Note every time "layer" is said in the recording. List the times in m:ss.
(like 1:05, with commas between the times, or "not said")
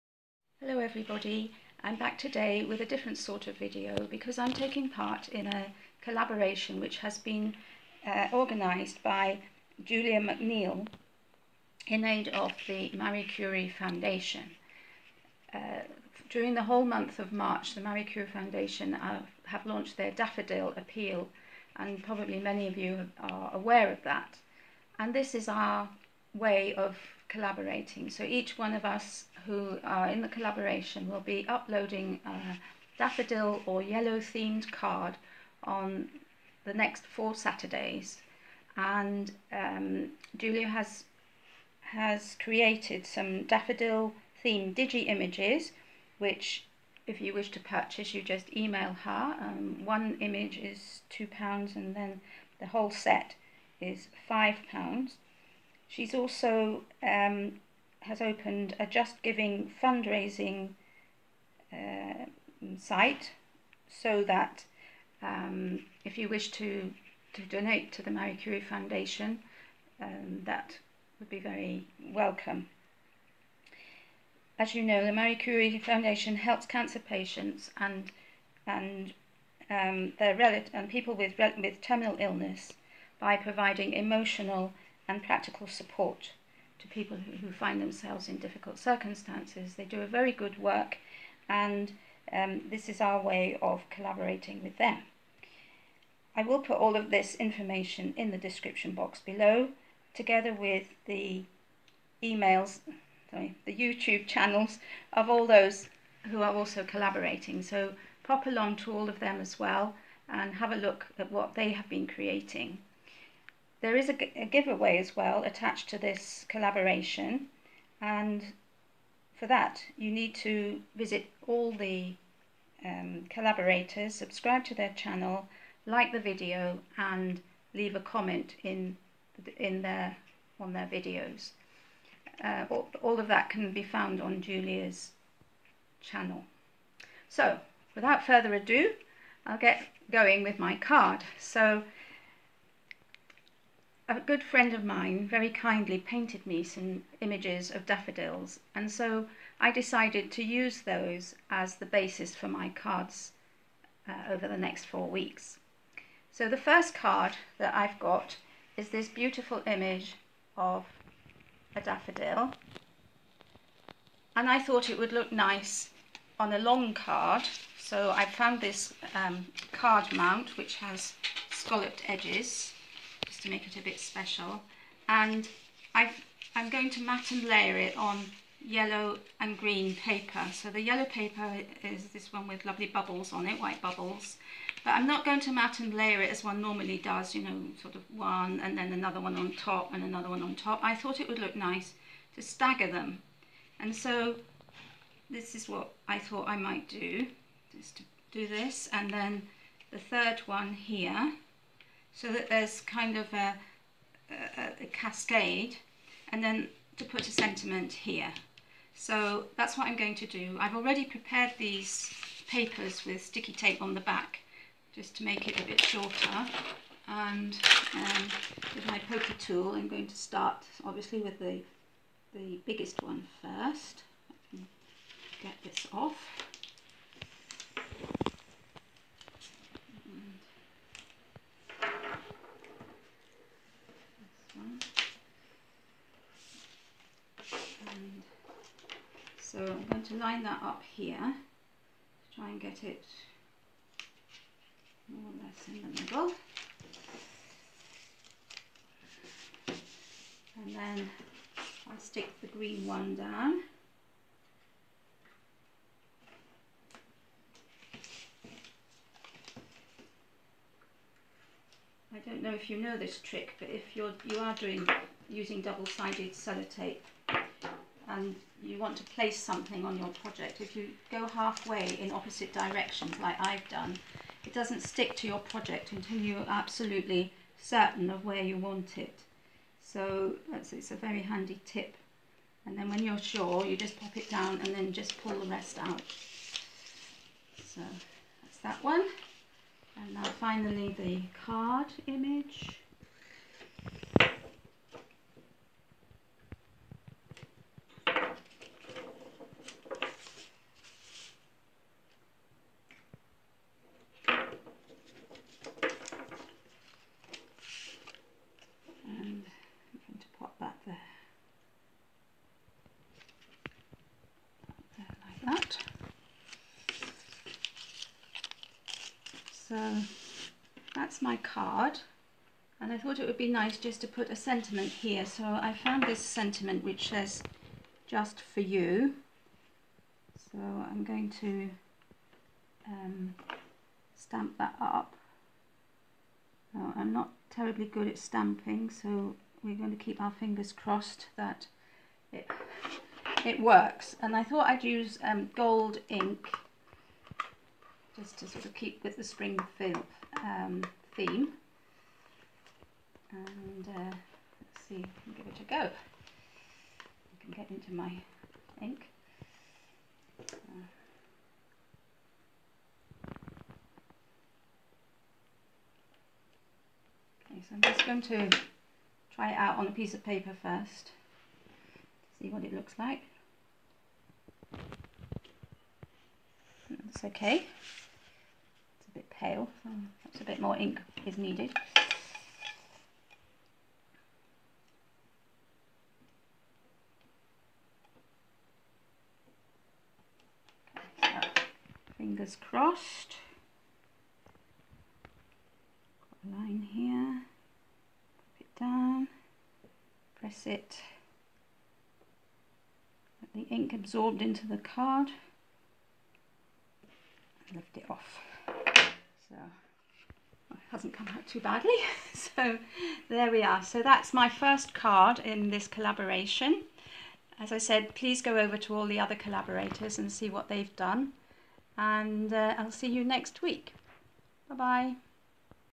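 2:57, 3:05.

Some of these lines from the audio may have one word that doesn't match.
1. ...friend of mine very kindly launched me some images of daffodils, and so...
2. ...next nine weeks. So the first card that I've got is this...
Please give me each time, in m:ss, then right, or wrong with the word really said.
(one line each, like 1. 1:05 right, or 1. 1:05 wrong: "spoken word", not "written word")
1. 2:24 wrong: "painted", not "launched"
2. 2:34 wrong: "four", not "nine".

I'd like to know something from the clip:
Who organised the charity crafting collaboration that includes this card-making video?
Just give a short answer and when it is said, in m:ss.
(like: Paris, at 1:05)
Julia McNeill, at 0:09.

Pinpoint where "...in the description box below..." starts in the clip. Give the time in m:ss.
1:38.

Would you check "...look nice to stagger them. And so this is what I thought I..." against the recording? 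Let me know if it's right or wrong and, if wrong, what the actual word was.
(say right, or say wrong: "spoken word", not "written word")
right.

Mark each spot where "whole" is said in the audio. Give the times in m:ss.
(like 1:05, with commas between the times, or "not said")
0:16, 0:52.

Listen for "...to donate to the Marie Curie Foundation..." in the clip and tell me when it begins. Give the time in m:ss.
1:07.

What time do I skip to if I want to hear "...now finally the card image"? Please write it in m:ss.
4:50.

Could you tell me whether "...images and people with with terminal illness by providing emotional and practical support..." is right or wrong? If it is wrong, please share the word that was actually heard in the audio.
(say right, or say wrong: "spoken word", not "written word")
wrong: "relatives", not "images".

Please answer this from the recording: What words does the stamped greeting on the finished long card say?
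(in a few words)
Just for you.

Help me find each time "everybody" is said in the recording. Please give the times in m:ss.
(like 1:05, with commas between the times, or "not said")
0:00.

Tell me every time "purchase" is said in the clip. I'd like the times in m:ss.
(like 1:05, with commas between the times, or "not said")
0:47.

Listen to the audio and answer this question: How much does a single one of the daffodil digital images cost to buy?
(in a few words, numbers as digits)
2 pounds.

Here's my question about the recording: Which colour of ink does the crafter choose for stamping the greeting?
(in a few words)
Gold.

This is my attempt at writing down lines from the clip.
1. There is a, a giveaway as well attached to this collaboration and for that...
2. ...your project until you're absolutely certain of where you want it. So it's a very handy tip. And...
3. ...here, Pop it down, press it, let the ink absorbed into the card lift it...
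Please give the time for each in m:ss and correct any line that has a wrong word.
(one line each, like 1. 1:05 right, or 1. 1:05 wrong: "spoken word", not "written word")
1. 1:53 right
2. 4:35 right
3. 6:36 right.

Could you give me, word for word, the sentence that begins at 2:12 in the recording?
Uh, all, all of that can be found on Julia's channel.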